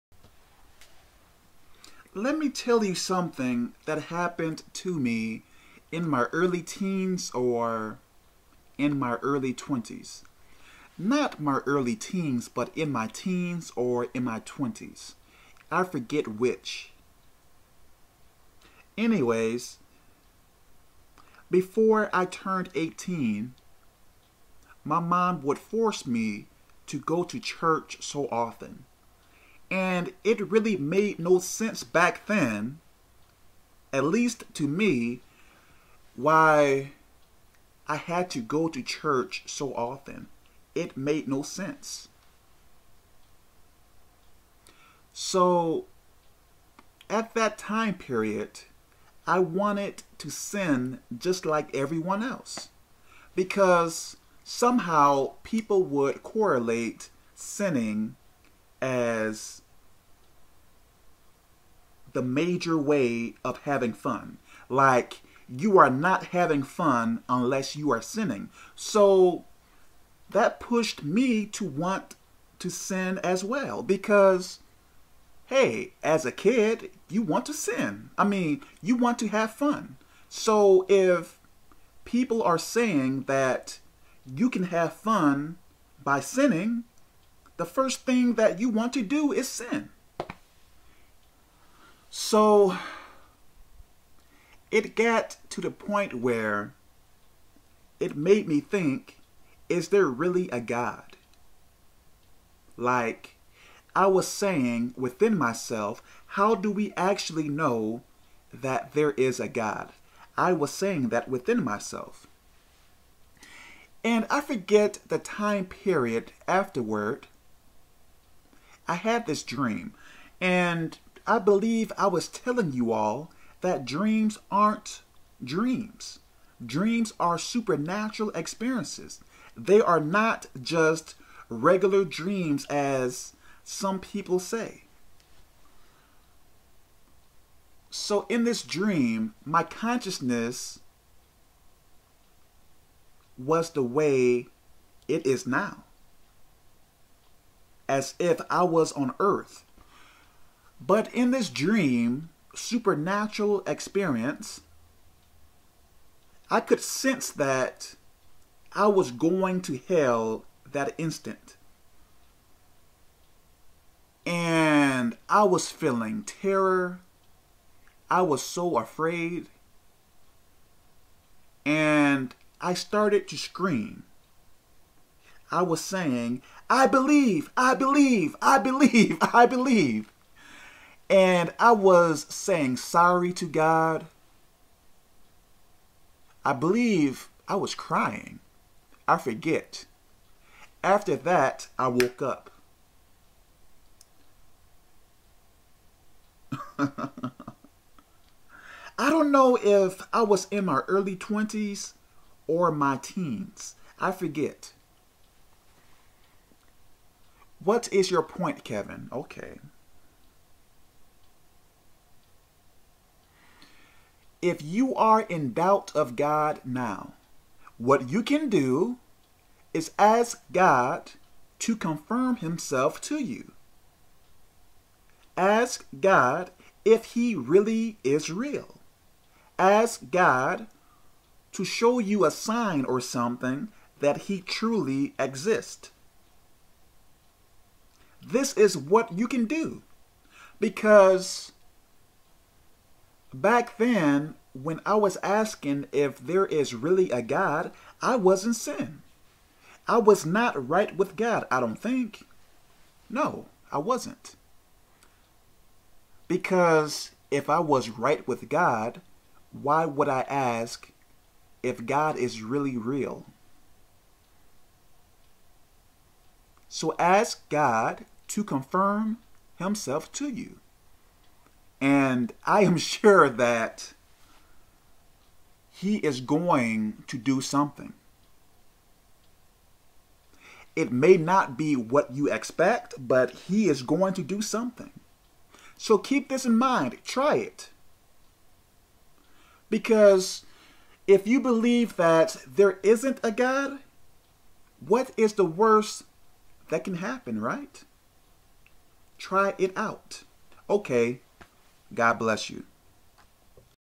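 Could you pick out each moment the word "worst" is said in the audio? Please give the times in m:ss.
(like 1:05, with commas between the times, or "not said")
4:55.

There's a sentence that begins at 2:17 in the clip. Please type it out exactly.
So, in this dream, my consciousness was the way it is now as if I was on earth.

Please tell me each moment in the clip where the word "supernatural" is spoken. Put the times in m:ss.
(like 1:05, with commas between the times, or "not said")
2:07, 2:32.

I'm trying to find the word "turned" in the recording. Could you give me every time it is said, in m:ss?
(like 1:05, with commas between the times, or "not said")
0:22.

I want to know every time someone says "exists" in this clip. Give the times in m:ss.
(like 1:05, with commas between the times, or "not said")
3:55.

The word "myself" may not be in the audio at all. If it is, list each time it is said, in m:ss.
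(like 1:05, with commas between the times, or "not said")
1:45, 1:51.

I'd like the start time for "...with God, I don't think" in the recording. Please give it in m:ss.
4:10.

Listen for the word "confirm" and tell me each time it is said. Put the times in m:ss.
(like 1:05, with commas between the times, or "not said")
3:41, 4:28.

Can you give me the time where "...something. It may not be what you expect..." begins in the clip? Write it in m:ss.
4:37.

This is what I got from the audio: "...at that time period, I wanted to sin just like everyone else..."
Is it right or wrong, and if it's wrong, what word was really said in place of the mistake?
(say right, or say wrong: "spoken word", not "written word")
right.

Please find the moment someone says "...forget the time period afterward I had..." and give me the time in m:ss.
1:54.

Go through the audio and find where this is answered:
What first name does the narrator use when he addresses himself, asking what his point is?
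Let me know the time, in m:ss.
3:28.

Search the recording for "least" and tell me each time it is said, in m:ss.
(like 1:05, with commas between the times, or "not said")
0:34.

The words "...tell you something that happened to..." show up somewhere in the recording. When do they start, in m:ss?
0:02.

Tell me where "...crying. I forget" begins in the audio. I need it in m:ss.
3:07.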